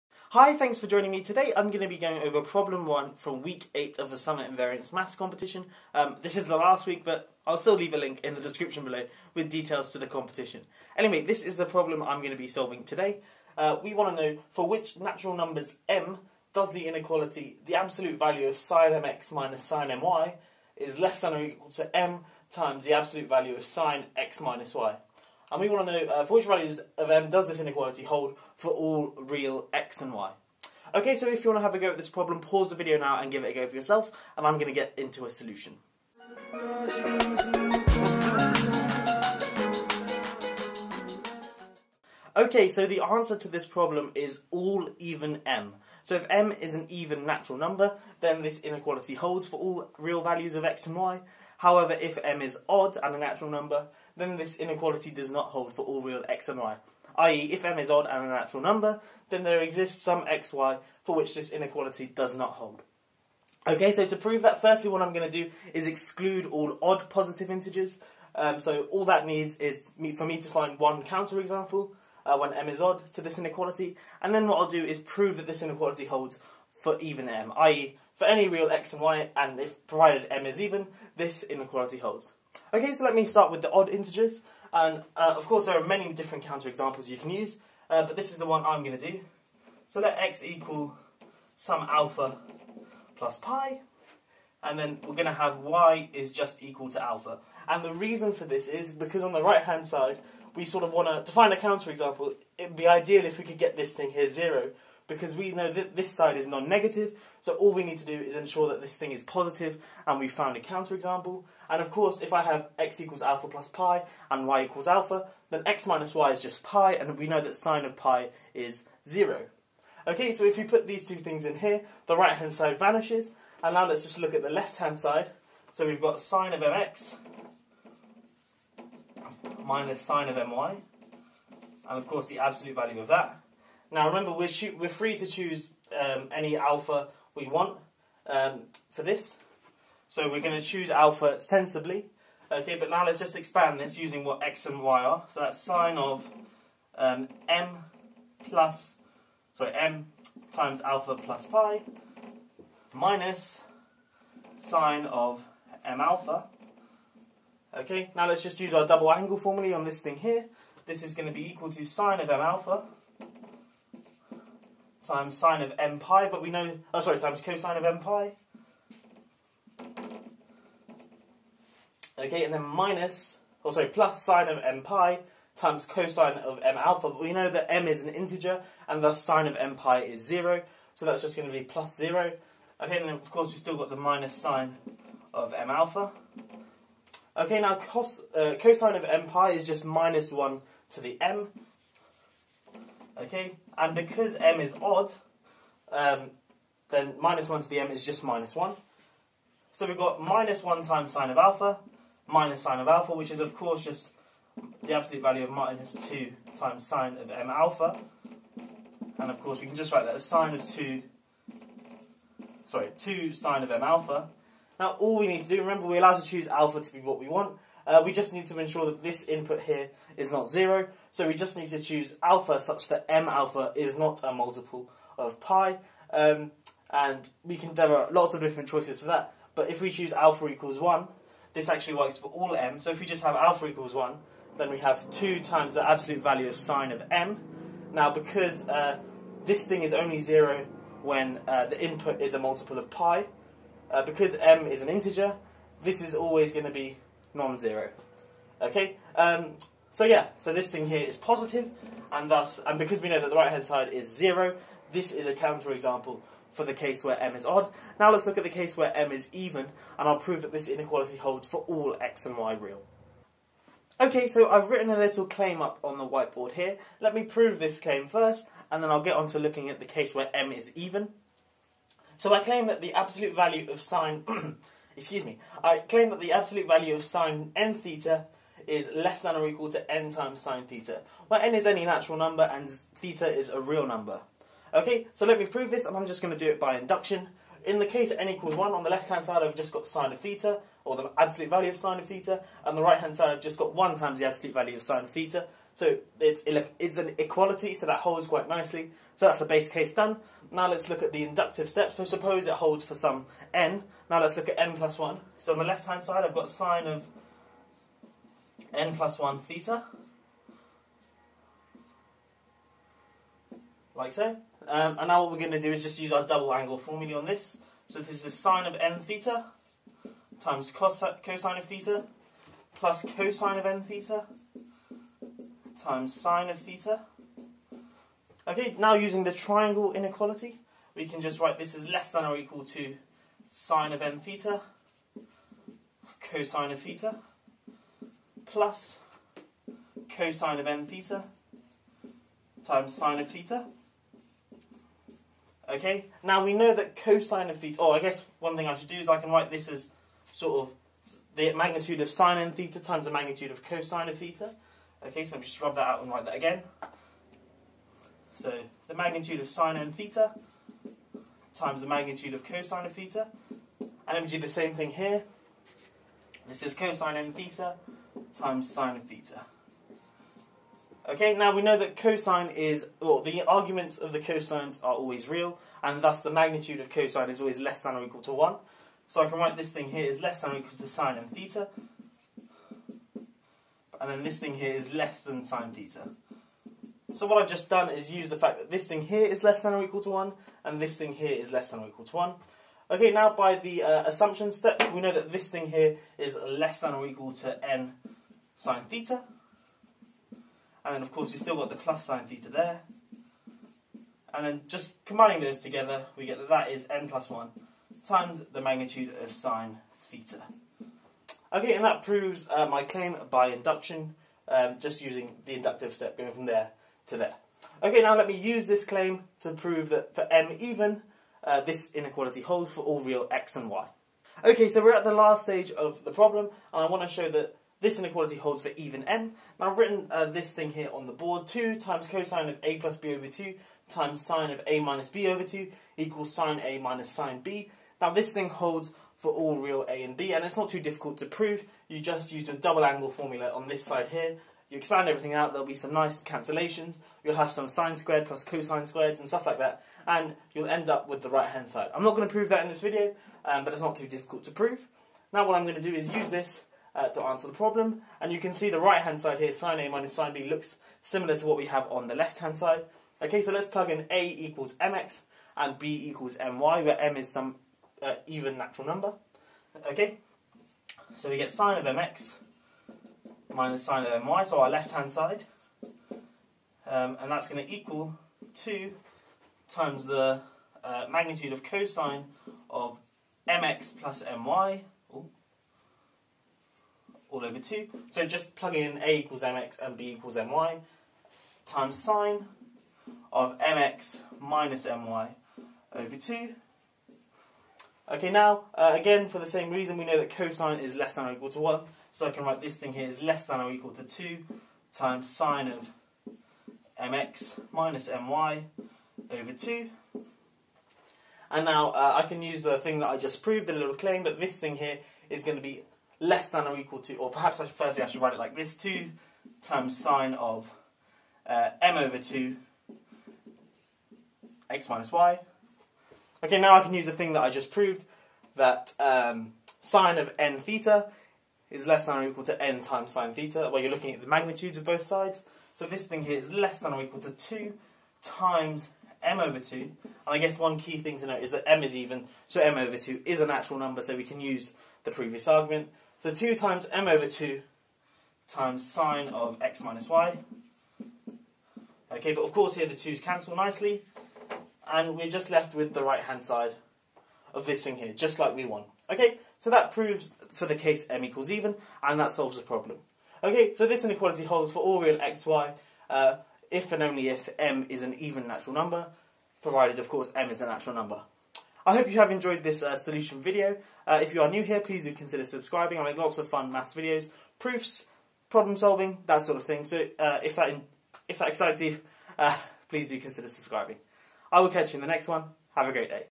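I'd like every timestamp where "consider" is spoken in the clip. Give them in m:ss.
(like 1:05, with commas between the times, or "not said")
9:35, 9:43.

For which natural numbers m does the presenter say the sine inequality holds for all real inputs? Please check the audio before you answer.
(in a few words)
All even m.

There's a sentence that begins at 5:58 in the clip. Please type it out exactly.
So the magnitude of sine and theta times the magnitude of cosine of theta.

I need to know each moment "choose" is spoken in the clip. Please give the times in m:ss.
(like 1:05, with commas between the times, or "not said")
2:15, 2:20, 3:36, 3:41, 3:49.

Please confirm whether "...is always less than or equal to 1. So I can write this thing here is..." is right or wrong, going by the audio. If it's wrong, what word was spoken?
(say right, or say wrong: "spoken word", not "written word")
right.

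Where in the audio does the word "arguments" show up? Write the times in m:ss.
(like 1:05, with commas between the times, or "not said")
6:13, 9:05.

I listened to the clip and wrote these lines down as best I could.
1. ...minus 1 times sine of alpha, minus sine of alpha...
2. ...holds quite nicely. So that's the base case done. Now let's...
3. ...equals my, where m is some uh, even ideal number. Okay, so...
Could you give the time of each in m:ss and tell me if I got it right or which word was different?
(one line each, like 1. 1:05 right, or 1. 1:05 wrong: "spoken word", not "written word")
1. 3:20 right
2. 4:57 right
3. 7:46 wrong: "natural", not "ideal".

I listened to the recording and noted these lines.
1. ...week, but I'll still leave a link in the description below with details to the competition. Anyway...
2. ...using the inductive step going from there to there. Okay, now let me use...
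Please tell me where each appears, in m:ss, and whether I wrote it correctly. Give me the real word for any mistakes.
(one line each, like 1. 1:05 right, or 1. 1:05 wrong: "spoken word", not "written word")
1. 0:06 right
2. 6:55 right.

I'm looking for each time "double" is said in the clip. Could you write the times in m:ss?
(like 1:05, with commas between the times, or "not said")
2:38, 5:16, 7:22.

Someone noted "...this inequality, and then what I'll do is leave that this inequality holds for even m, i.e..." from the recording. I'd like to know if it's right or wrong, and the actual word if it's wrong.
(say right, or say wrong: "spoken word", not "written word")
wrong: "prove", not "leave".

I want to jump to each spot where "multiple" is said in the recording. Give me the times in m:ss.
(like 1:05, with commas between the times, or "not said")
3:44, 4:02.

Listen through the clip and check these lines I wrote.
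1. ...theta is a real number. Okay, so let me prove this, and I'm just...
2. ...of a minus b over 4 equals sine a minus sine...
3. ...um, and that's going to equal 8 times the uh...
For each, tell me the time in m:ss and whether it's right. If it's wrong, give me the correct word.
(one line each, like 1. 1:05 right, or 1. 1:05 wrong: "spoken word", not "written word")
1. 4:42 right
2. 7:14 wrong: "2", not "4"
3. 7:56 wrong: "2", not "8".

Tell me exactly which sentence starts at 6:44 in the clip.
And then just combining those together, we get that that is n plus 1 times the magnitude of sine theta.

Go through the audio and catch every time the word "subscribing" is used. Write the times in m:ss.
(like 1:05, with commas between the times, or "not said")
9:35, 9:43.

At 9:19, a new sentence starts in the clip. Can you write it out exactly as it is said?
Okay, so that proves for the case m equals even, and that solves the problem.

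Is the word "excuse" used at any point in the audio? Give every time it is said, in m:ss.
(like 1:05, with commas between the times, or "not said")
4:34.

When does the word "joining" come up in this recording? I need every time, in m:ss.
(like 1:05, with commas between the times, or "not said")
0:00.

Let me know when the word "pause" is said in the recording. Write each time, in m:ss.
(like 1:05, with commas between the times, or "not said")
0:32.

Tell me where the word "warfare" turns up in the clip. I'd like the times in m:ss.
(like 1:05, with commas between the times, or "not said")
not said.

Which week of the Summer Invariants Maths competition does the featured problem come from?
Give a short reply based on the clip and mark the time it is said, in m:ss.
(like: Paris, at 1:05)
Week 8, at 0:03.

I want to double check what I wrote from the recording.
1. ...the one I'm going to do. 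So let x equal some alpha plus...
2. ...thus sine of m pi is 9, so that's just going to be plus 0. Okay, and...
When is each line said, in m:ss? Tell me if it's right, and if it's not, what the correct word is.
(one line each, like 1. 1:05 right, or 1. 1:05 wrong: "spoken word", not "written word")
1. 1:28 right
2. 2:59 wrong: "0", not "9".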